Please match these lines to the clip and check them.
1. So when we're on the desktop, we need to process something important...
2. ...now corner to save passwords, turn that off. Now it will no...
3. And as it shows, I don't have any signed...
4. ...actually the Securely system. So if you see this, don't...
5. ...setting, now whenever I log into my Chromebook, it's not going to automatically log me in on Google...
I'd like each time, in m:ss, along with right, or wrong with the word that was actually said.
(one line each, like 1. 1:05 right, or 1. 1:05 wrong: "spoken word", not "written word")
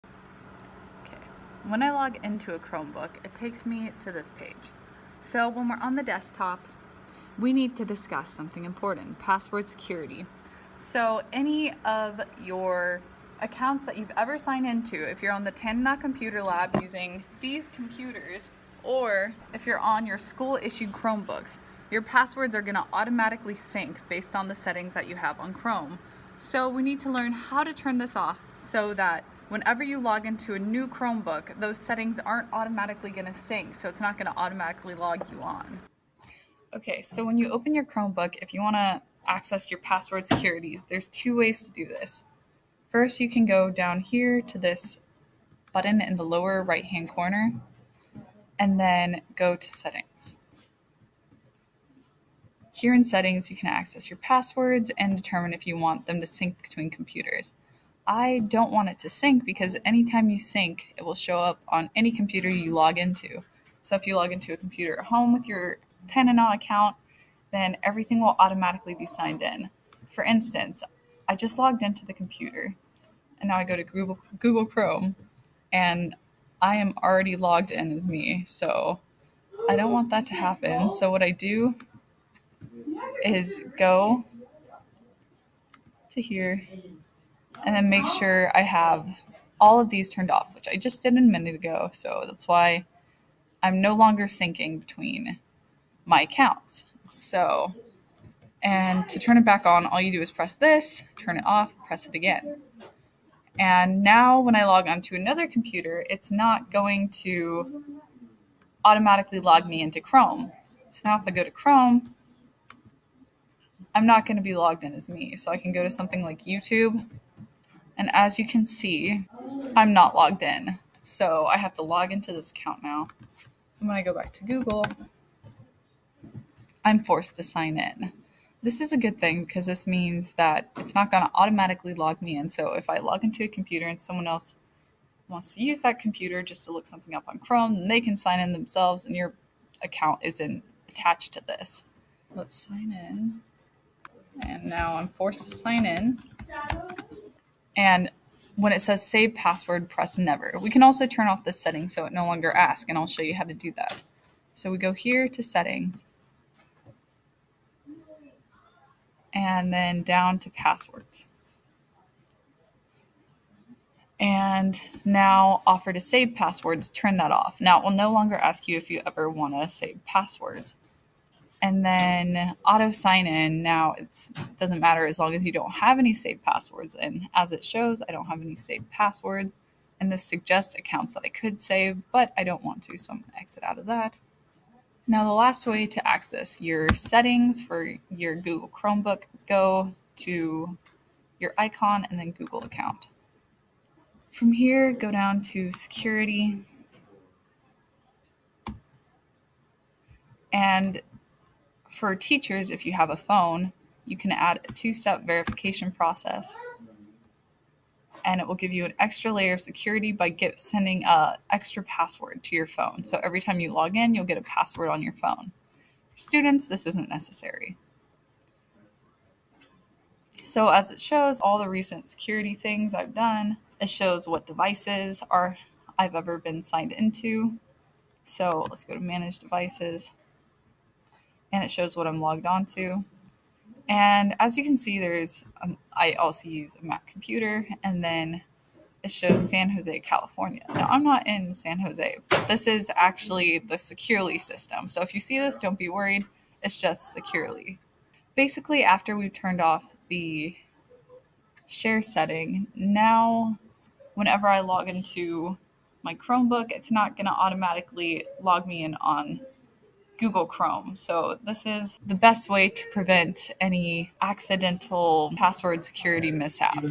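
1. 0:05 wrong: "discuss", not "process"
2. 2:45 wrong: "offer", not "corner"
3. 2:56 wrong: "saved", not "signed"
4. 4:02 right
5. 4:12 right.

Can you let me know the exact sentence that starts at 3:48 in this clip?
So let's go to manage devices and it shows what I'm logged on to.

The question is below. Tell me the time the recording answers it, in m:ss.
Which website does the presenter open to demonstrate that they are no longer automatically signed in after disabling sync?
1:56.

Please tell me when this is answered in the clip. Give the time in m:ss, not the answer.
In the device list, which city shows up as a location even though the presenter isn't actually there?
3:59.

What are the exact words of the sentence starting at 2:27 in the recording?
And when it says save password, press never.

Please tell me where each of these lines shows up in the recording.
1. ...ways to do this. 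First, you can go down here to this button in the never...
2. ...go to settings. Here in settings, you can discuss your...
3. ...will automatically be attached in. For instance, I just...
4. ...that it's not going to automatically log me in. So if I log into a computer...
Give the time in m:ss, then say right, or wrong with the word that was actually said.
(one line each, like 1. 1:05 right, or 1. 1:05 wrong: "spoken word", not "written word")
1. 0:41 wrong: "lower", not "never"
2. 0:49 wrong: "access", not "discuss"
3. 1:08 wrong: "signed", not "attached"
4. 2:10 right.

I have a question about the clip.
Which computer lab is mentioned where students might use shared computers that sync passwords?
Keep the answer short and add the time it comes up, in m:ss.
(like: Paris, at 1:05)
Tanana Computer Lab, at 0:15.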